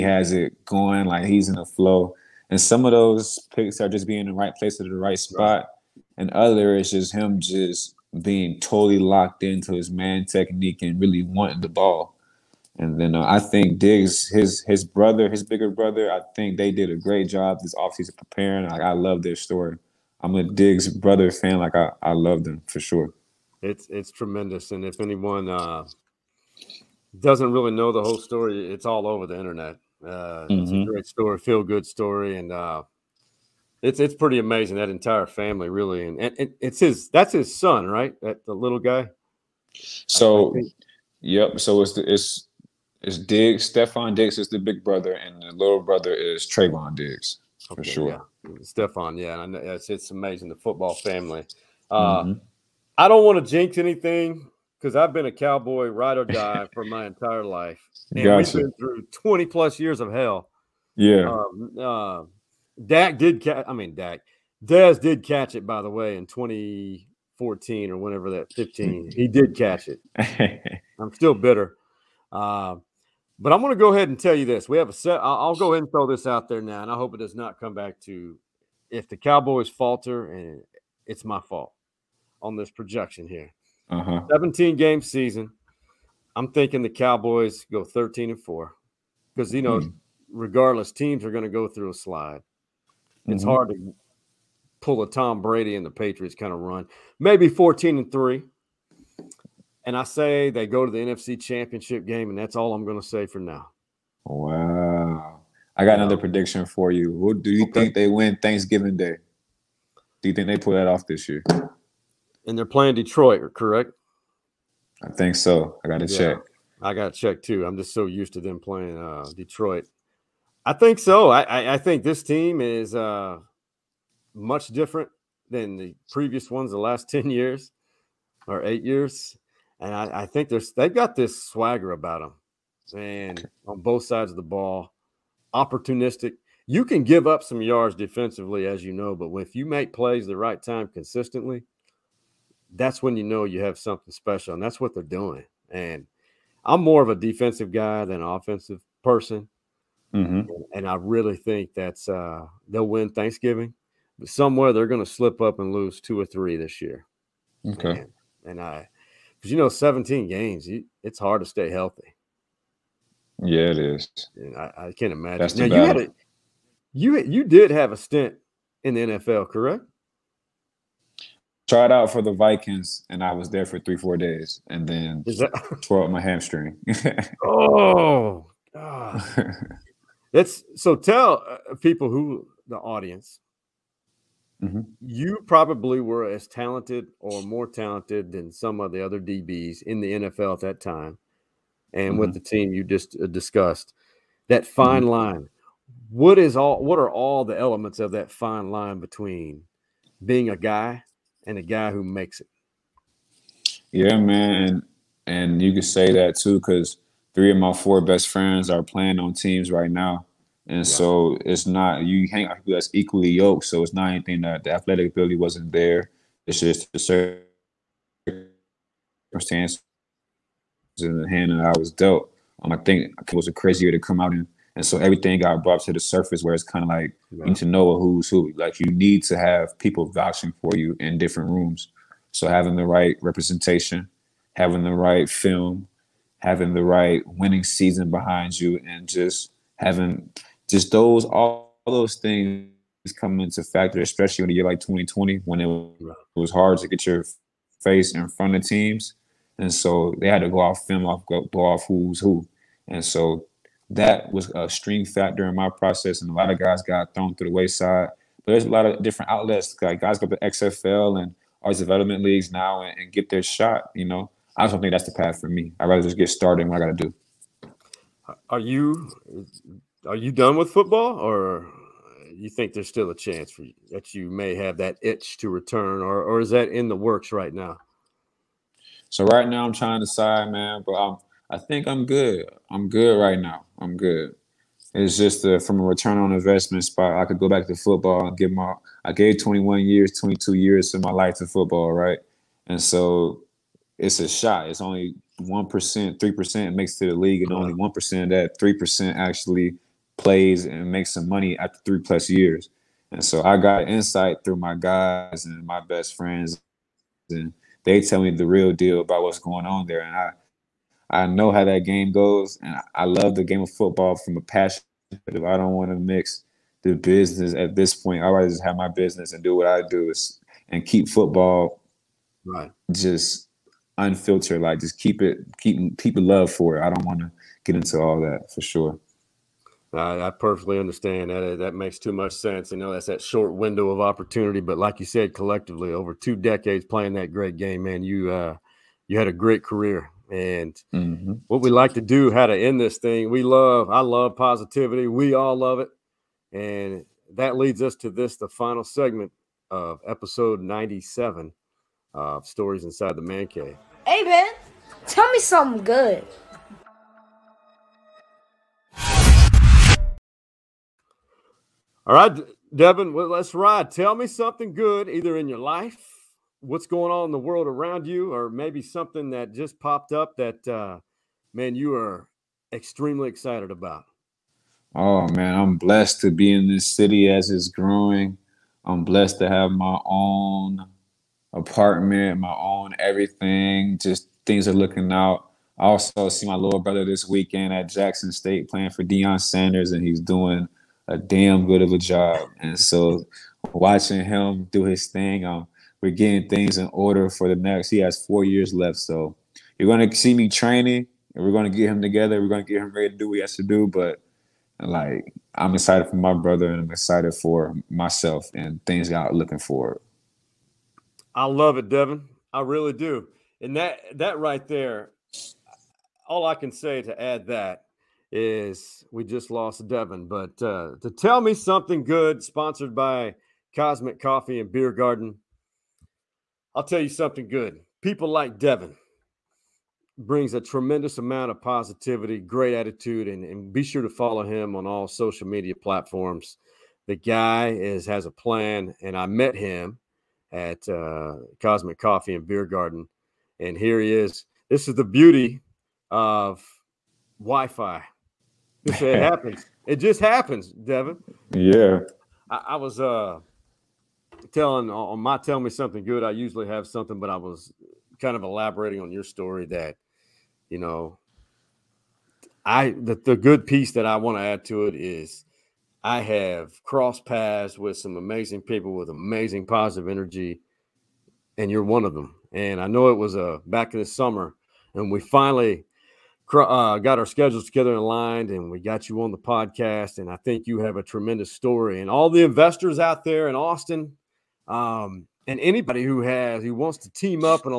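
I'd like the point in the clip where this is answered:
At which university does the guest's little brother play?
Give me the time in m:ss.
6:27.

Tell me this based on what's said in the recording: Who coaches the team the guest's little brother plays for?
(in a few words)
Deion Sanders.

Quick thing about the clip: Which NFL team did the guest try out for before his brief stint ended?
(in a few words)
Vikings.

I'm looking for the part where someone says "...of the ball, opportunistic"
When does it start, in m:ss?
2:14.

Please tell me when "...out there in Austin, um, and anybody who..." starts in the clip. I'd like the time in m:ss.
8:02.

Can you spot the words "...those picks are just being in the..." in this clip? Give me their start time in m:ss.
0:02.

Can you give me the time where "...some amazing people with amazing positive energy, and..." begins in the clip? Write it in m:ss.
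7:47.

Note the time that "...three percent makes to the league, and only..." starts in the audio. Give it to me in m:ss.
4:56.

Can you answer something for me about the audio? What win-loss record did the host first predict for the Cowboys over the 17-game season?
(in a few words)
13 and 4.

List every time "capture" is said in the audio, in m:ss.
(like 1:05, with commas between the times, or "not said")
not said.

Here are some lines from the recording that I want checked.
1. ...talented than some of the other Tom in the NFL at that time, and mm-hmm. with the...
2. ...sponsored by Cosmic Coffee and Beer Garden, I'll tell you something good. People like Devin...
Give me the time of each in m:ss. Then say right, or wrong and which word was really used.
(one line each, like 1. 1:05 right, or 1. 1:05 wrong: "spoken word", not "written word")
1. 3:07 wrong: "DBs", not "Tom"
2. 7:02 right.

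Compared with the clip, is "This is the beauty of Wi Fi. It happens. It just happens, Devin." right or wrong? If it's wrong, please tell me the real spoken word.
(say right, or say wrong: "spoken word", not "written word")
right.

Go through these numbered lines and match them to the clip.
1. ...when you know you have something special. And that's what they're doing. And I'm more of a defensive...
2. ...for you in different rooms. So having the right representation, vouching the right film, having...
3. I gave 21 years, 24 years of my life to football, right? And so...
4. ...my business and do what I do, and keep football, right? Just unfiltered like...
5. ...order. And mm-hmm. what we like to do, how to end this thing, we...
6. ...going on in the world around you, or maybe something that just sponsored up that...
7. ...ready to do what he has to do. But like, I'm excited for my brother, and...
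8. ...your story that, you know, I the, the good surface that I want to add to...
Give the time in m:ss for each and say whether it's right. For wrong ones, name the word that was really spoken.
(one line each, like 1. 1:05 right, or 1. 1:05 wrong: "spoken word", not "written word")
1. 2:23 right
2. 3:50 wrong: "having", not "vouching"
3. 4:49 wrong: "22", not "24"
4. 5:18 right
5. 5:39 wrong: "career", not "order"
6. 6:06 wrong: "popped", not "sponsored"
7. 6:42 right
8. 7:39 wrong: "piece", not "surface".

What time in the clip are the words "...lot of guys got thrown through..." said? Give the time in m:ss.
4:16.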